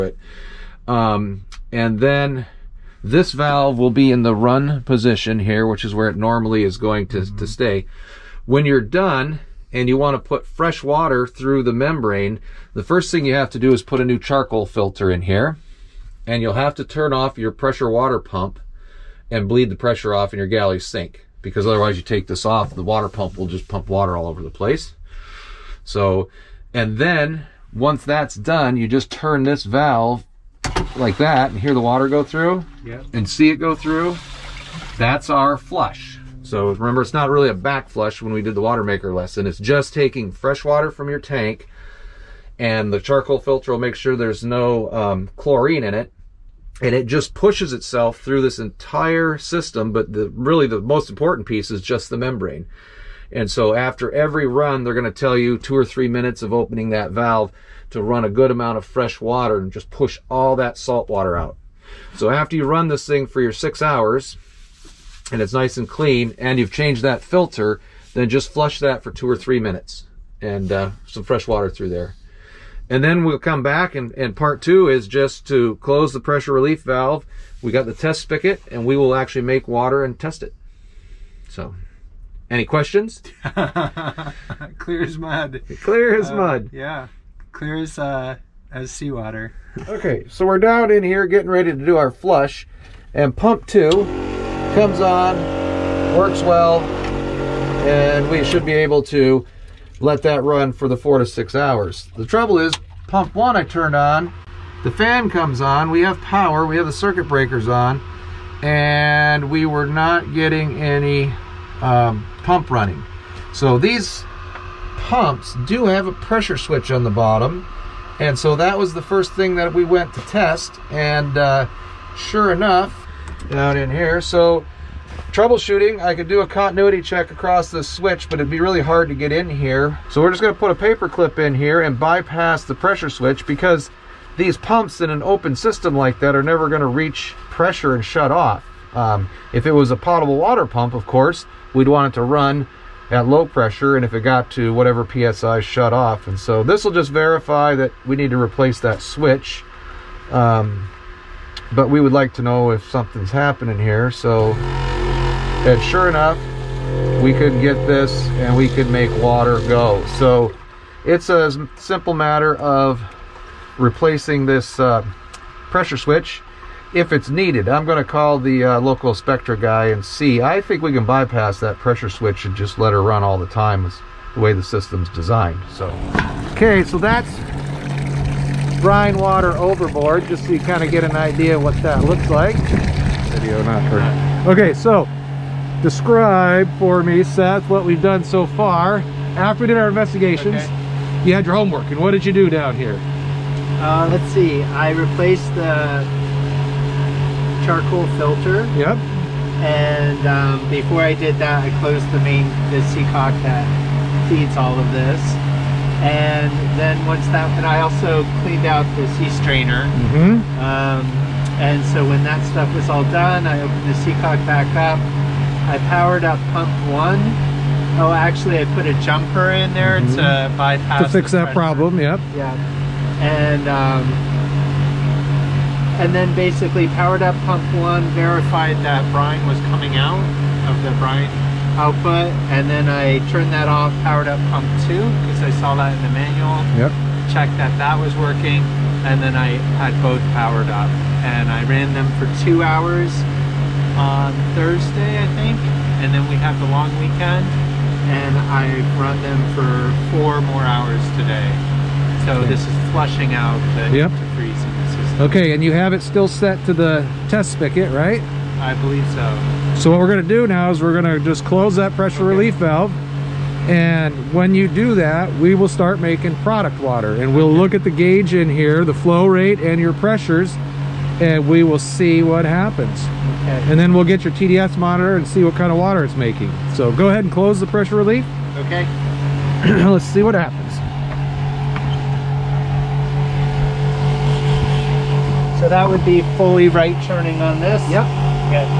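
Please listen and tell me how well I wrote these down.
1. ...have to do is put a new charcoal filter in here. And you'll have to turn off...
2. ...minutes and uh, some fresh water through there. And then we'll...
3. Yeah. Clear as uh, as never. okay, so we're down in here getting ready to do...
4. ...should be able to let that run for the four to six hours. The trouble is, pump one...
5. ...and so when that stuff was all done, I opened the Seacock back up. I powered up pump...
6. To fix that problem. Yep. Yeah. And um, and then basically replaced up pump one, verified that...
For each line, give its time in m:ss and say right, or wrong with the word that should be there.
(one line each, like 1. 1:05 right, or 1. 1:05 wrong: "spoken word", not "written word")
1. 0:13 right
2. 1:09 right
3. 1:26 wrong: "seawater", not "never"
4. 1:38 right
5. 3:31 right
6. 3:41 wrong: "powered", not "replaced".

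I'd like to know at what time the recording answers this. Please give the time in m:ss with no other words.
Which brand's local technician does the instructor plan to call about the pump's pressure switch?
2:49.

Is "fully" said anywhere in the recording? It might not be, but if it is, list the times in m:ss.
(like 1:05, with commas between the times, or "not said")
4:46.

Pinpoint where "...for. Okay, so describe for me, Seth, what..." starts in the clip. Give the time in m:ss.
3:03.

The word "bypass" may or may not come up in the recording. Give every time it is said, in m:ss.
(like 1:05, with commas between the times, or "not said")
2:11, 2:51, 3:40.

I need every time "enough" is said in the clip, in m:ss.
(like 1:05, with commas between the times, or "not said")
2:02, 2:36.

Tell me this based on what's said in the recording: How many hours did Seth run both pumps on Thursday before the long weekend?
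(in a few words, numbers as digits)
2.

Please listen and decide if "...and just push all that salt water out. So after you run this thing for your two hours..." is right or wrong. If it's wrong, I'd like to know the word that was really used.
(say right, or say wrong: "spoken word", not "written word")
wrong: "six", not "two".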